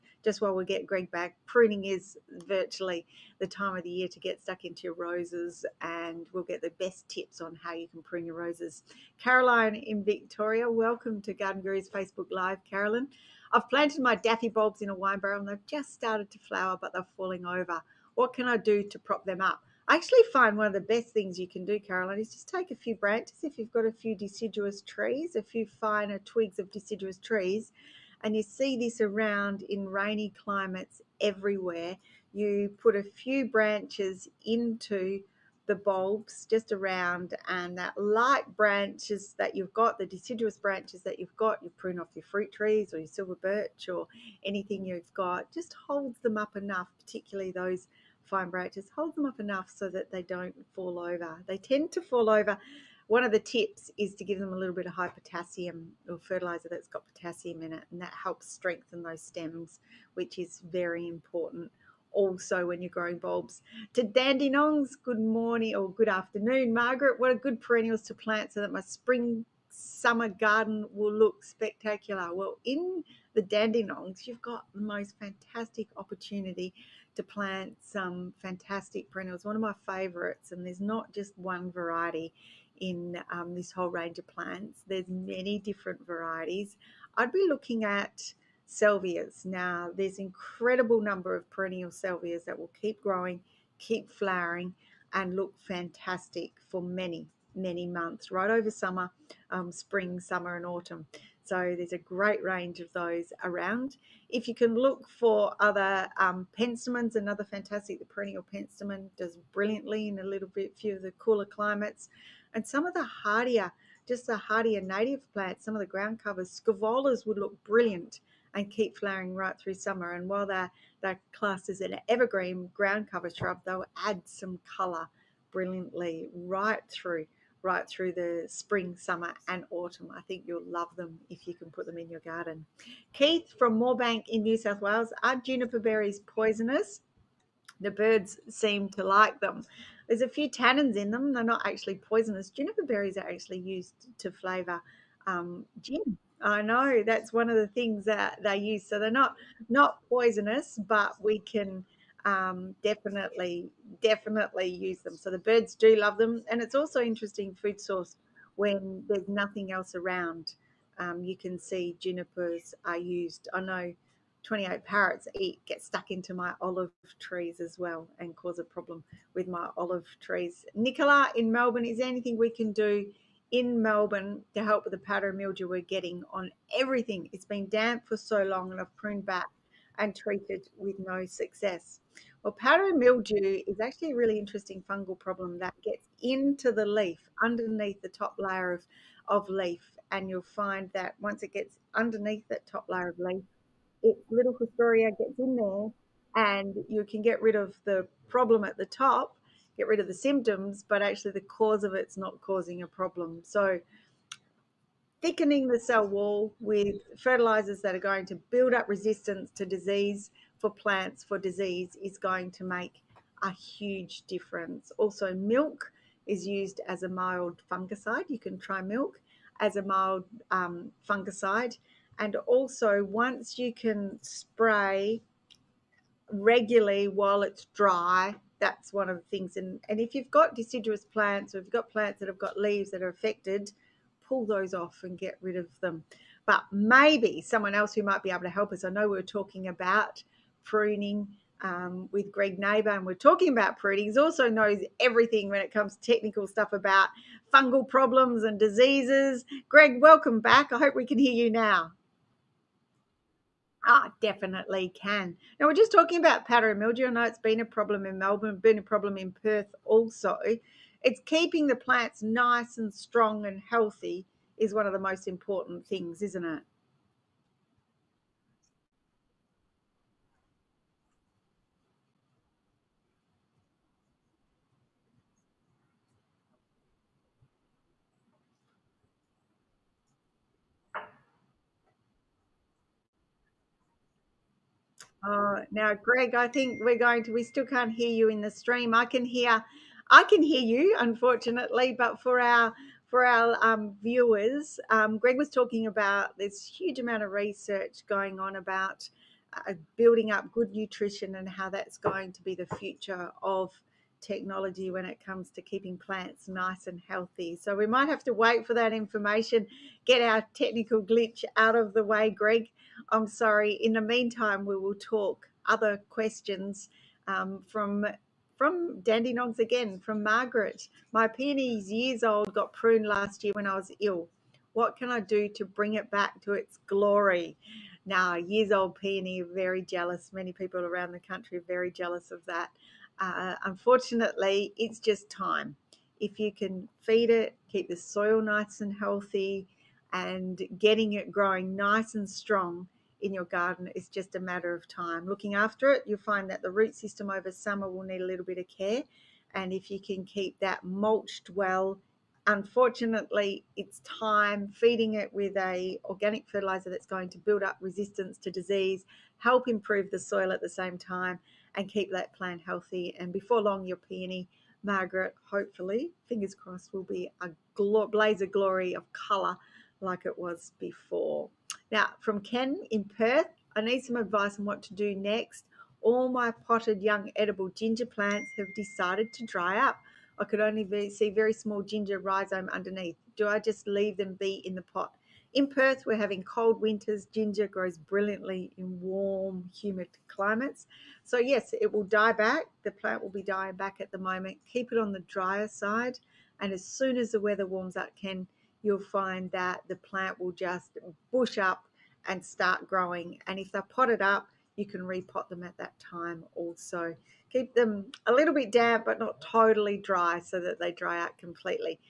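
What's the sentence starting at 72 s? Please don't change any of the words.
Well, in the Nongs, you've got the most fantastic opportunity to plant some fantastic perennials, one of my favorites.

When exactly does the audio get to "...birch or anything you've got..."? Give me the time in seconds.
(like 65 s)
43 s.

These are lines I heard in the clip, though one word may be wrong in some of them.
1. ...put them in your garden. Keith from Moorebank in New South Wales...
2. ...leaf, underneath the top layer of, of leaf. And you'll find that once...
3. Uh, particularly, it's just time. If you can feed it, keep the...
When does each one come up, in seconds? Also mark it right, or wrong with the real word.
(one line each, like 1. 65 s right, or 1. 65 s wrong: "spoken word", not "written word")
1. 131 s right
2. 186 s right
3. 333 s wrong: "unfortunately", not "particularly".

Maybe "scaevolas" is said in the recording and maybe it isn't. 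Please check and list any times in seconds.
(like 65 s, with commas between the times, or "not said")
116 s.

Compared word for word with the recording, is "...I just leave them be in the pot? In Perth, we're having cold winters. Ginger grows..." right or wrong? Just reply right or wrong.
right.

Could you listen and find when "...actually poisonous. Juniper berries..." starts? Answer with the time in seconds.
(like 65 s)
141 s.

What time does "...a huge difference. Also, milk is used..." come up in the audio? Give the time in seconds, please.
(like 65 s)
213 s.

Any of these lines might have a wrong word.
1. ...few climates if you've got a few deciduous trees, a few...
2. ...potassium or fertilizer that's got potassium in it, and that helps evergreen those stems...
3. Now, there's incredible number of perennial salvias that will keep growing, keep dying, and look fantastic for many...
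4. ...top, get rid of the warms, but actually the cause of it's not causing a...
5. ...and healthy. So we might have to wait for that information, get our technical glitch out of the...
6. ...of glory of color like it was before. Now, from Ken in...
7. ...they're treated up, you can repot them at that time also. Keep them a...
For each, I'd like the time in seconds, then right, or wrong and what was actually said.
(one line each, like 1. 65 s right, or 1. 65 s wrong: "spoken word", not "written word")
1. 22 s wrong: "branches", not "climates"
2. 55 s wrong: "strengthen", not "evergreen"
3. 89 s wrong: "flowering", not "dying"
4. 198 s wrong: "symptoms", not "warms"
5. 306 s right
6. 368 s right
7. 403 s wrong: "potted", not "treated".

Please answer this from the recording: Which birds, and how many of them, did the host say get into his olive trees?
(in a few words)
28 parrots.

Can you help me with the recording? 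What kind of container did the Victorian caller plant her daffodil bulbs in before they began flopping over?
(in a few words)
wine barrel.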